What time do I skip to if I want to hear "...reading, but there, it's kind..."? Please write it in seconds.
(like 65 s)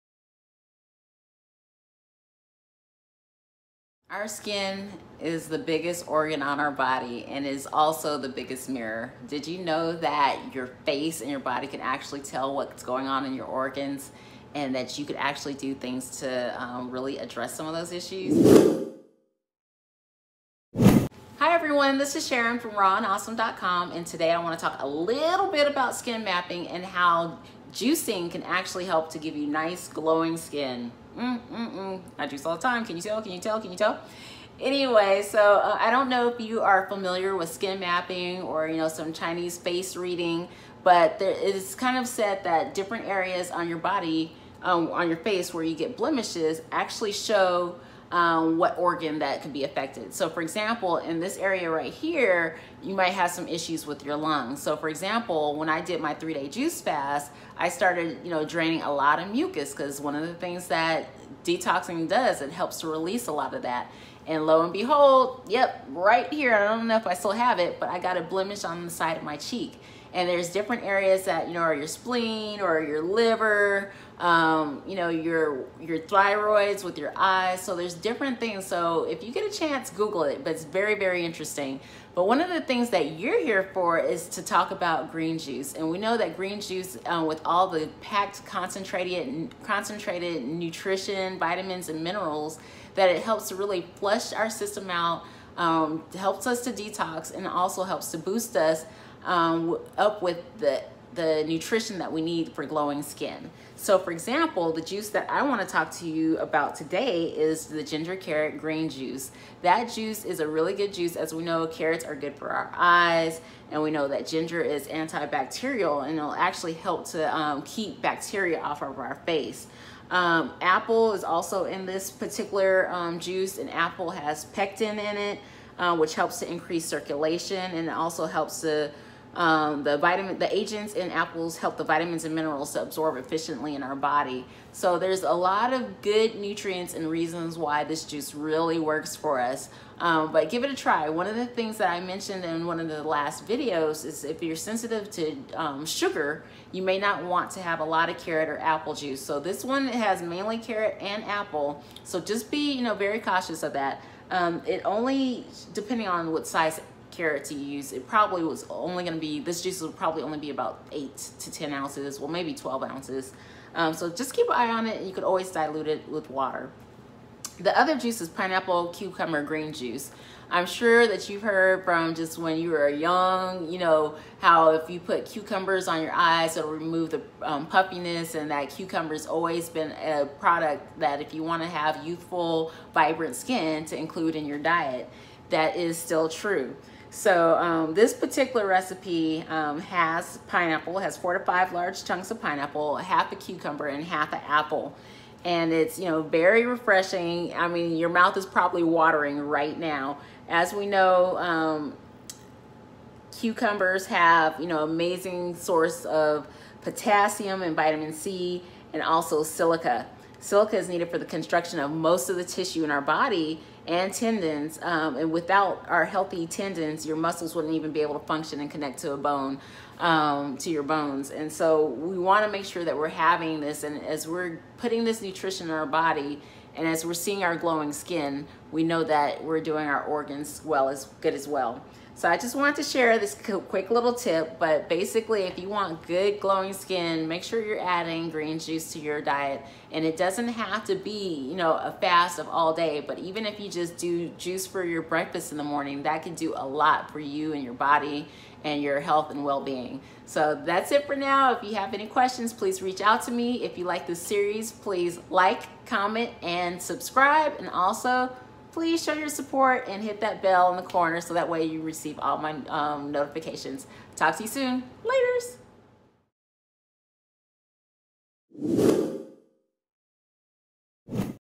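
39 s.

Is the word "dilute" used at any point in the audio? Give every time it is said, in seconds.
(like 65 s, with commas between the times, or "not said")
165 s.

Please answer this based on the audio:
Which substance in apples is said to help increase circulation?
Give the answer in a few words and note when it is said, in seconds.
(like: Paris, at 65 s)
pectin, at 124 s.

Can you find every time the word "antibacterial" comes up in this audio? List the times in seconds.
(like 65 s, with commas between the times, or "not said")
114 s.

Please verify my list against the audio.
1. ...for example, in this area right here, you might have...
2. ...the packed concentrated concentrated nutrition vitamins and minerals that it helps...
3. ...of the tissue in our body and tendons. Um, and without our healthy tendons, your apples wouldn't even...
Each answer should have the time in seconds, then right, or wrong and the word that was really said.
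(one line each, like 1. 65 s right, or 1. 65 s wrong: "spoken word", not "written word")
1. 50 s right
2. 87 s right
3. 212 s wrong: "muscles", not "apples".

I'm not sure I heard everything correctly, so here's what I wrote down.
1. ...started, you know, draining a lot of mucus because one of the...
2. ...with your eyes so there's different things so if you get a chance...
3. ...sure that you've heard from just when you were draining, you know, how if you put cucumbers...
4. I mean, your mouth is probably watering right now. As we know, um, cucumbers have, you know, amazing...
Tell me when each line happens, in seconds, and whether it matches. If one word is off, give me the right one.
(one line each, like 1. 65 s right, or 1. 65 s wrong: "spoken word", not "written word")
1. 57 s right
2. 76 s right
3. 170 s wrong: "young", not "draining"
4. 197 s right.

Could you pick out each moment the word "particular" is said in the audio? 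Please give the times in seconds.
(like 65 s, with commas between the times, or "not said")
122 s, 188 s.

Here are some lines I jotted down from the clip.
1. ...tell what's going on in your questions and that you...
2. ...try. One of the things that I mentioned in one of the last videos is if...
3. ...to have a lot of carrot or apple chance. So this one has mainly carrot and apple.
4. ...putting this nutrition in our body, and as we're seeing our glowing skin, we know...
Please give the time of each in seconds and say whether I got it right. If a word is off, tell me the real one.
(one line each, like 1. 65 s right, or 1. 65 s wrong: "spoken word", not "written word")
1. 12 s wrong: "organs", not "questions"
2. 140 s right
3. 147 s wrong: "juice", not "chance"
4. 224 s right.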